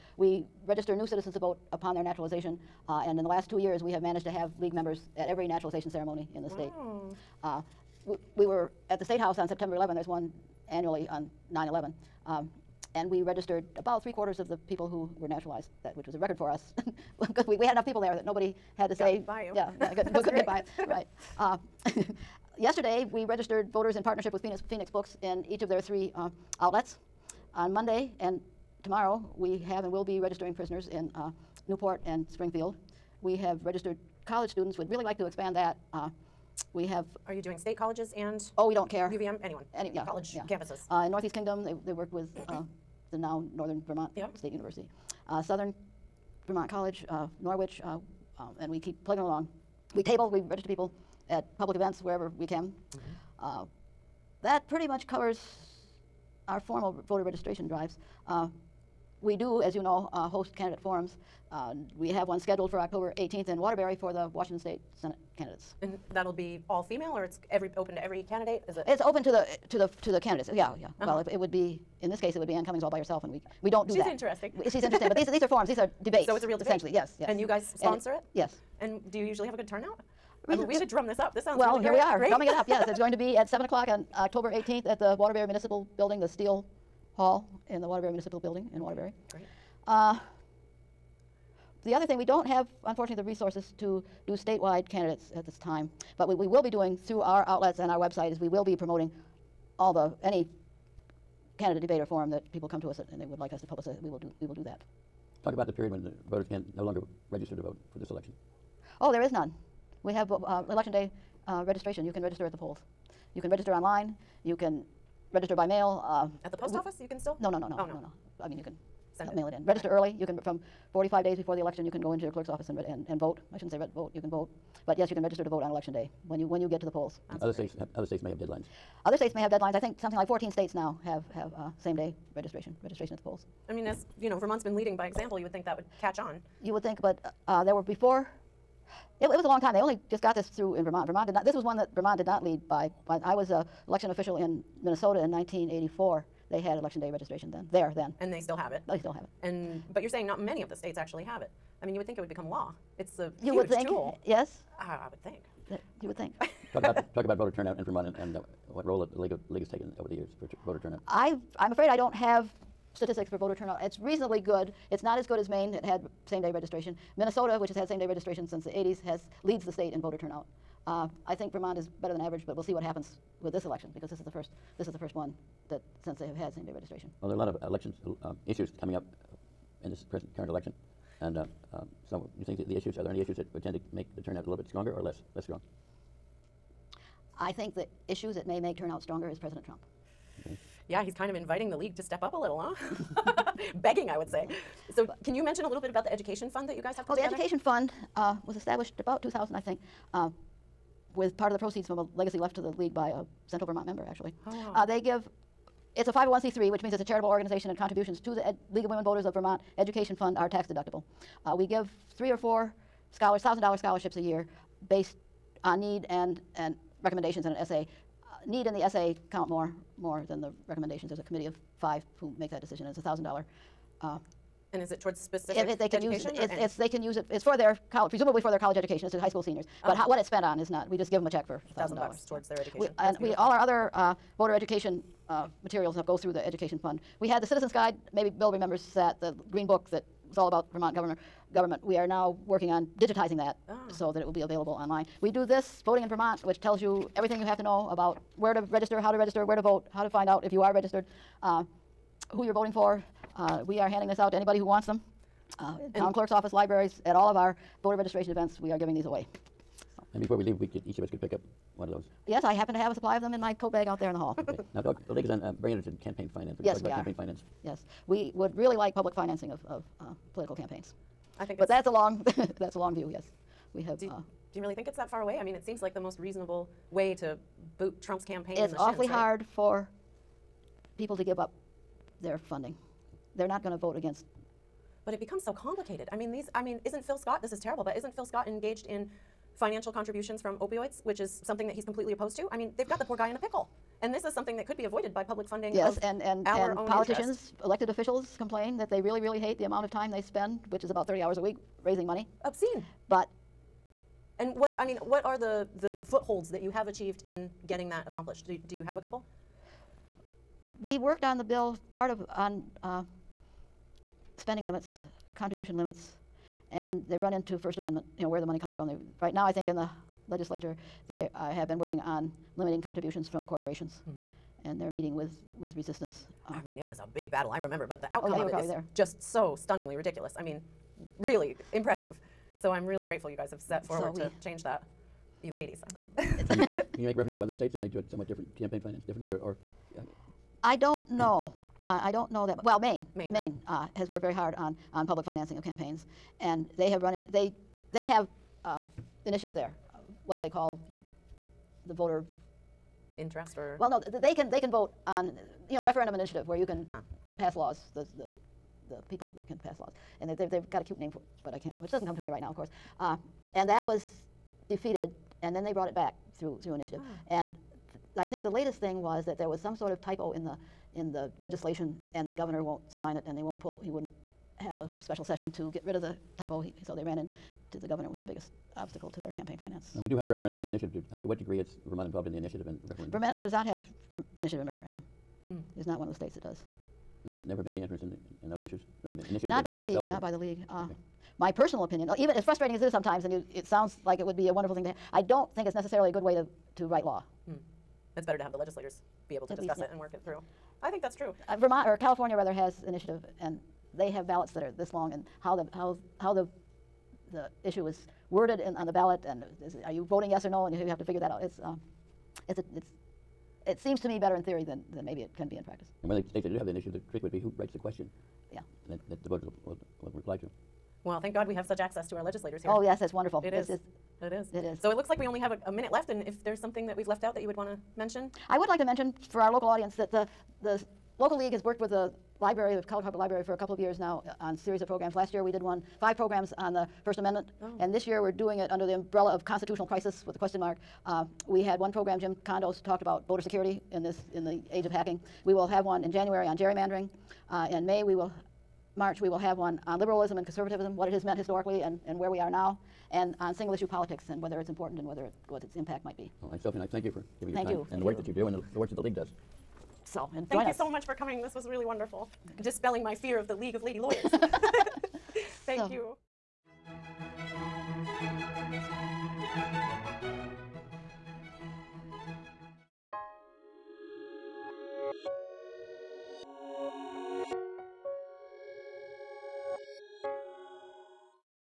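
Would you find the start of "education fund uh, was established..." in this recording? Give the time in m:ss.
3:17.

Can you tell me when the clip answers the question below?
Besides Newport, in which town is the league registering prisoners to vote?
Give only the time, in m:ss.
0:32.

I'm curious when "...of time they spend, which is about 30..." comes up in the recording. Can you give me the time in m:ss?
4:59.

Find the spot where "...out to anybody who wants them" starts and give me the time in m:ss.
4:14.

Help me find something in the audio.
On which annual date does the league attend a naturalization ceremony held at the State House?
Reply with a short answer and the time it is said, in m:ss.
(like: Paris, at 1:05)
September 11, at 0:09.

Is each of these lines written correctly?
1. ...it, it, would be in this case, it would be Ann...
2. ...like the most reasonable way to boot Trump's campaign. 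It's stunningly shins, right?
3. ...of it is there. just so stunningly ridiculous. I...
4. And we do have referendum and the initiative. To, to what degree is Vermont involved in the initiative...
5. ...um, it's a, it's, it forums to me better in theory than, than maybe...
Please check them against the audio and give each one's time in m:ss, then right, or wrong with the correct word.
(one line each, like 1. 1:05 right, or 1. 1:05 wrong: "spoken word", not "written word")
1. 1:11 right
2. 4:35 wrong: "awfully", not "stunningly"
3. 5:28 right
4. 6:19 right
5. 6:51 wrong: "seems", not "forums".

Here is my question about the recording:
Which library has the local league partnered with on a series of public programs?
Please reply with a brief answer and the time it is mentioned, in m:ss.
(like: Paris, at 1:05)
Kellogg-Hubbard Library, at 7:12.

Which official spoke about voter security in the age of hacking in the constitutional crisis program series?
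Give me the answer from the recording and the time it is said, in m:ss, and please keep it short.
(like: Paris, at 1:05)
Jim Condos, at 7:22.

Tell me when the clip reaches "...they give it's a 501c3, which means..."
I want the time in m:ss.
3:24.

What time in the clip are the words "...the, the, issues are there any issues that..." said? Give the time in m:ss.
3:02.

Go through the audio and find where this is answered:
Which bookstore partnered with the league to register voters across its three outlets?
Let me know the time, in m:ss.
0:24.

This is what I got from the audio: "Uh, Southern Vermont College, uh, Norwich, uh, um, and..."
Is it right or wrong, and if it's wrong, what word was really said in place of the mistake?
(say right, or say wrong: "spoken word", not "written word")
right.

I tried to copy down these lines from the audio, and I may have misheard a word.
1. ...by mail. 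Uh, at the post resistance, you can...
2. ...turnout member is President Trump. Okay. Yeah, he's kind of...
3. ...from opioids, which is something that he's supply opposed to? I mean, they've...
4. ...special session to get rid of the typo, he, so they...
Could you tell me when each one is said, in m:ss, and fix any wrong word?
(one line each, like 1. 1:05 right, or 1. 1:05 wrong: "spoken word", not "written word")
1. 1:55 wrong: "office", not "resistance"
2. 3:08 wrong: "stronger", not "member"
3. 4:50 wrong: "completely", not "supply"
4. 6:15 right.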